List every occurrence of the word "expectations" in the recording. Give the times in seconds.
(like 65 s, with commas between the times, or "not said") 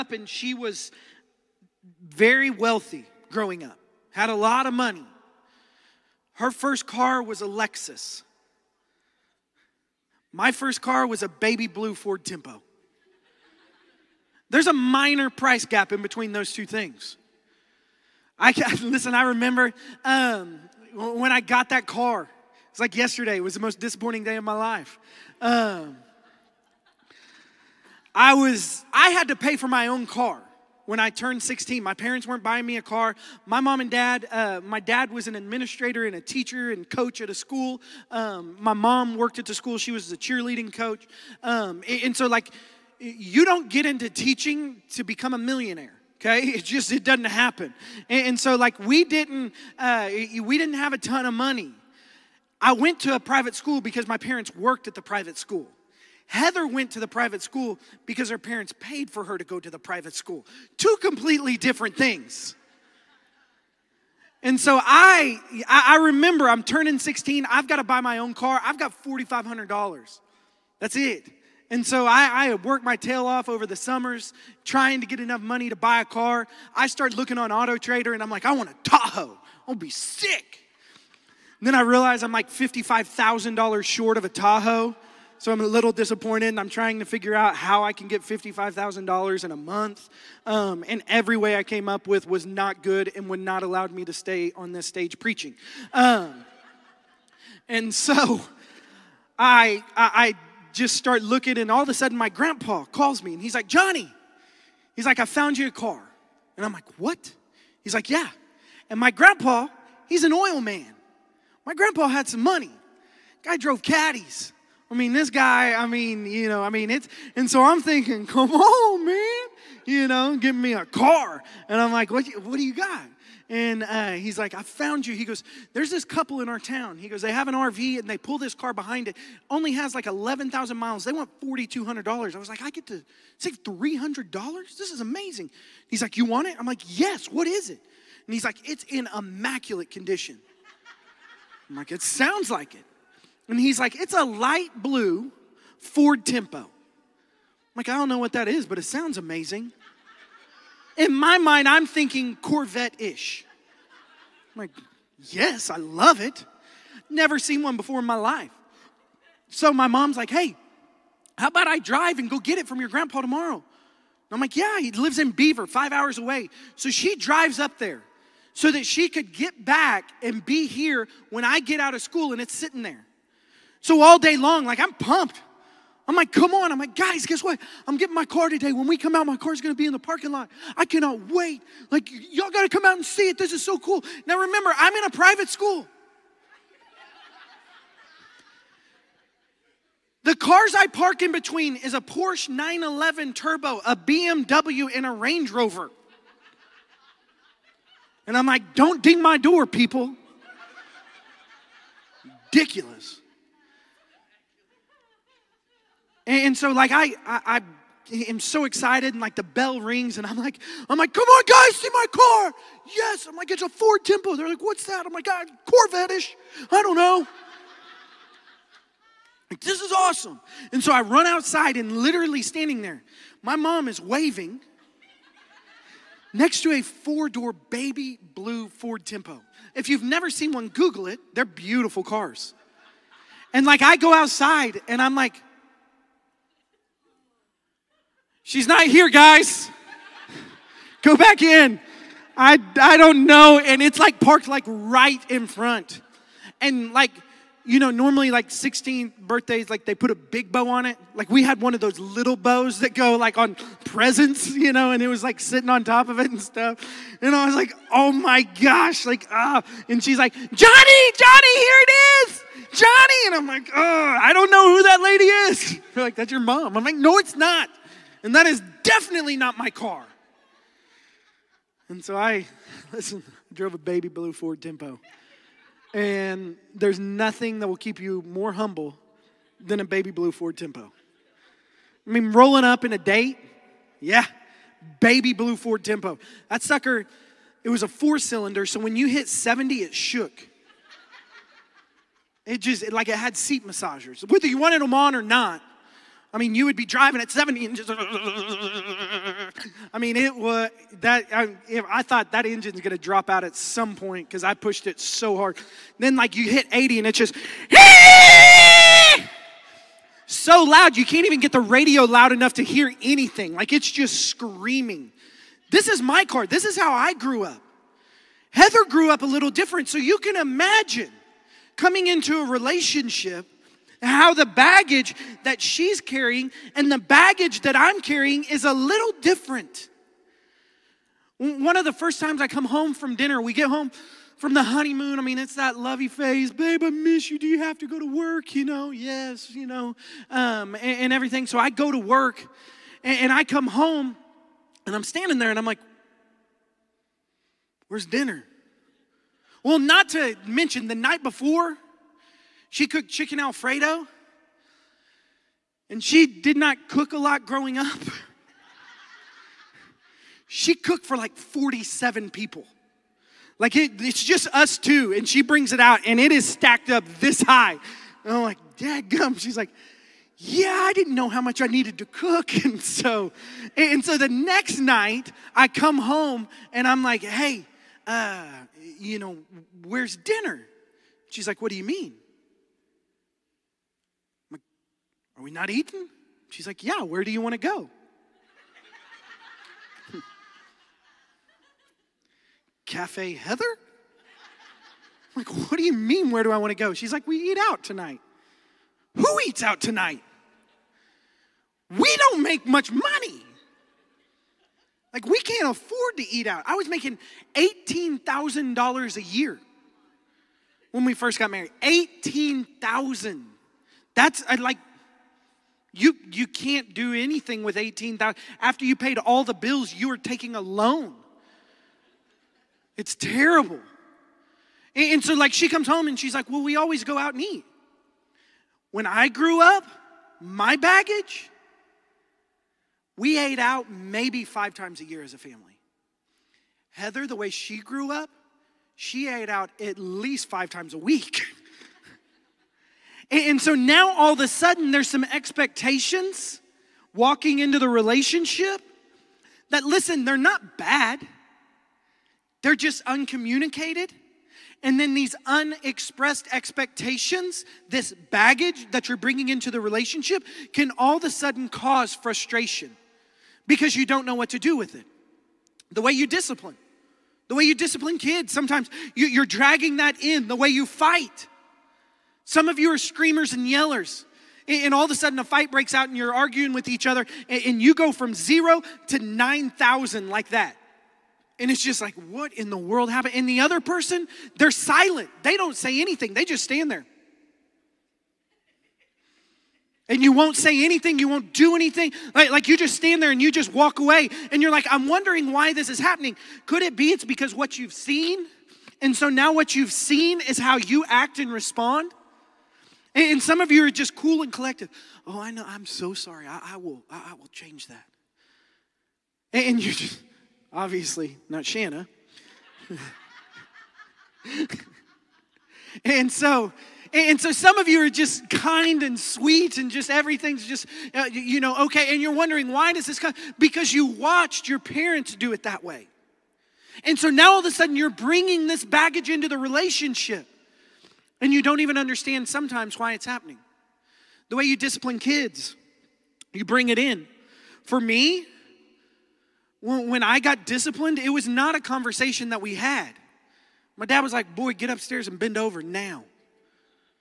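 445 s, 456 s.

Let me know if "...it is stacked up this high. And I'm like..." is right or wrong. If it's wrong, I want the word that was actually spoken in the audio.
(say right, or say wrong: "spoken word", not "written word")
right.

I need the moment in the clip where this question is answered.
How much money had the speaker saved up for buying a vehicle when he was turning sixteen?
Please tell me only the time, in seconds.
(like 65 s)
69 s.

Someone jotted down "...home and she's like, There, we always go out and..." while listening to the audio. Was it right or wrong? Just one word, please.
wrong.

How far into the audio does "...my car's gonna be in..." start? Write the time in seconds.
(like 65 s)
179 s.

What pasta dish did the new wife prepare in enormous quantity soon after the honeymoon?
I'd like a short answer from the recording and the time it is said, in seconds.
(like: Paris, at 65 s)
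Chicken Alfredo, at 353 s.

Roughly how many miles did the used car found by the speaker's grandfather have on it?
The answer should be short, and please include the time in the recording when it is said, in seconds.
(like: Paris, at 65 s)
11,000, at 130 s.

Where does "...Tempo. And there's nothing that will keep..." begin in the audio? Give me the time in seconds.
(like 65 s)
274 s.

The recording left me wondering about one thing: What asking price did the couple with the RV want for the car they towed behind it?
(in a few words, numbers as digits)
$4,200.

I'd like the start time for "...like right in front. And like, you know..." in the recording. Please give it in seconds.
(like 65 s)
244 s.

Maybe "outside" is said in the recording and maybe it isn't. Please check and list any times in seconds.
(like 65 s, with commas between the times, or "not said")
221 s, 234 s.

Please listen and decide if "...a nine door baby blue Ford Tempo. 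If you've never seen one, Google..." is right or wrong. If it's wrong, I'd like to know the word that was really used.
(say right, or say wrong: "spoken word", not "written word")
wrong: "four", not "nine".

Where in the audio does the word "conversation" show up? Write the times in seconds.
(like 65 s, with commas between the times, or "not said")
541 s.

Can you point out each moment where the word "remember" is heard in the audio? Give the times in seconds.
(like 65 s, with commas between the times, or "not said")
19 s, 65 s, 184 s.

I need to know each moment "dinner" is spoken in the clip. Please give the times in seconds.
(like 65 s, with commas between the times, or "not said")
333 s, 348 s, 380 s.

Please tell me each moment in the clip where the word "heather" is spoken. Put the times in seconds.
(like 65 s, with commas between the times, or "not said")
56 s, 318 s, 393 s, 436 s.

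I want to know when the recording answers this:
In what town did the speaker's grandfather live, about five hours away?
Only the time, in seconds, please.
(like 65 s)
165 s.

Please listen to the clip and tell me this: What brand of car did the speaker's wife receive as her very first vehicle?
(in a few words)
Lexus.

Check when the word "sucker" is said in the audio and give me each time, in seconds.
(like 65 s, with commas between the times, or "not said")
286 s.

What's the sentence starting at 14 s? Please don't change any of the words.
There's a minor price gap in between those two things.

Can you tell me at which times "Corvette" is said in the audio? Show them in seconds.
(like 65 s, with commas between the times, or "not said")
152 s, 215 s.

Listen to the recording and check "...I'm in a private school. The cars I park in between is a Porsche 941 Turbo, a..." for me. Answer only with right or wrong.
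wrong.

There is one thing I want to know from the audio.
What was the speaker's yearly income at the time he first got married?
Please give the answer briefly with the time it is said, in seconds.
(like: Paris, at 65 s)
$18,000, at 407 s.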